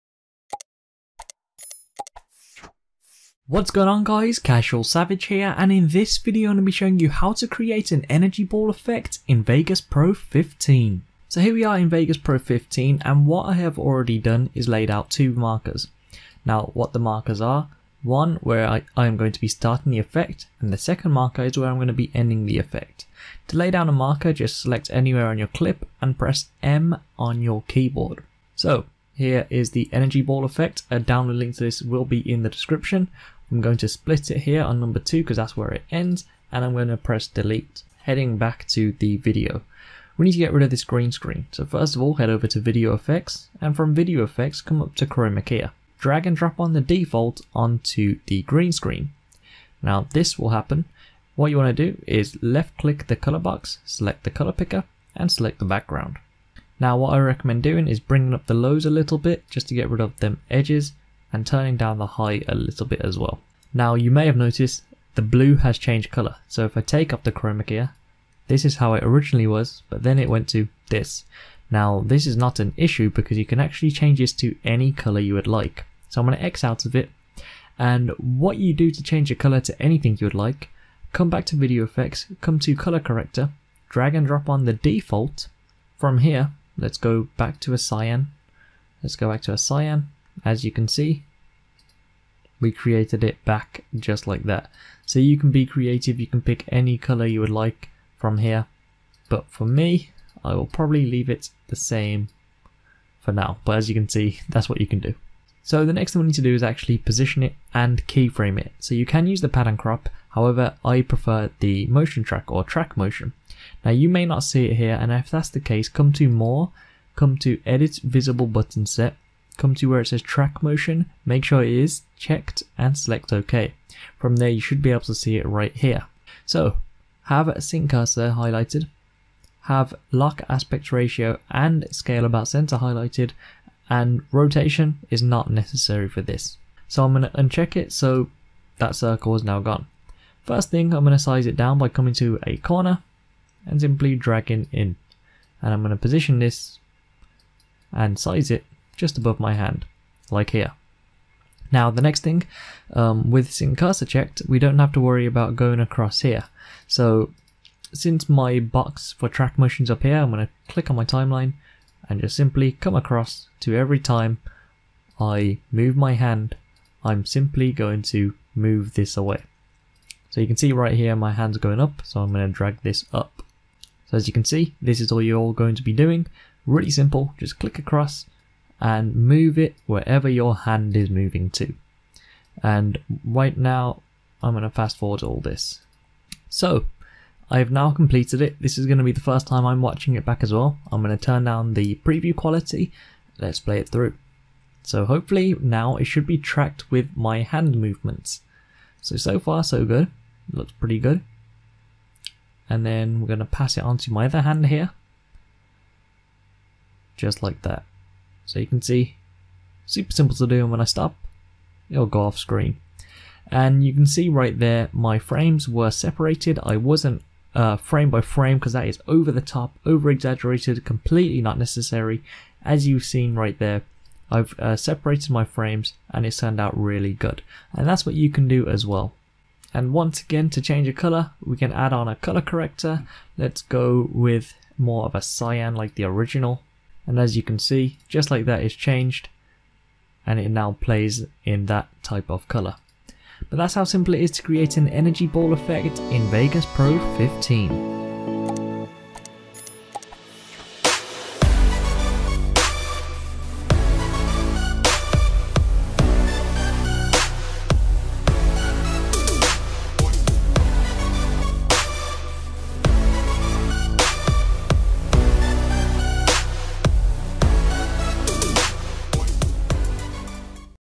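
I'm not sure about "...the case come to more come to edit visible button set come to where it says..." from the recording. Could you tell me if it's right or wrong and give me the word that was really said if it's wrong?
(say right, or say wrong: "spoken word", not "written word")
right.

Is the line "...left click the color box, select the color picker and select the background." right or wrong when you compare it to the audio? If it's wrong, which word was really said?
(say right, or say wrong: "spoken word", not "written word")
right.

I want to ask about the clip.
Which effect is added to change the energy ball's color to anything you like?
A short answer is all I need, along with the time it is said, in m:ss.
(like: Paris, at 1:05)
Colour Corrector, at 1:22.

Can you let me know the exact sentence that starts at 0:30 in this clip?
A download link to this will be in the description.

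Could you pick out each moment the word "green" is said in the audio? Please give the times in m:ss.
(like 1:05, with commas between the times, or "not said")
0:40, 0:48.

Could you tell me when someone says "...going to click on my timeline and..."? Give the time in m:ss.
2:40.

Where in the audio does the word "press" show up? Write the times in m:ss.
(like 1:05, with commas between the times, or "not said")
0:26, 0:36.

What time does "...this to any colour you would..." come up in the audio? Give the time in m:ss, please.
1:14.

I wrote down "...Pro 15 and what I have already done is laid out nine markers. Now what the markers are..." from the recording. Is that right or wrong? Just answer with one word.
wrong.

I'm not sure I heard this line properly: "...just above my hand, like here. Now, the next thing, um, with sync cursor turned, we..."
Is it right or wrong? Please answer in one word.
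wrong.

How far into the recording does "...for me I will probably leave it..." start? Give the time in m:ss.
1:39.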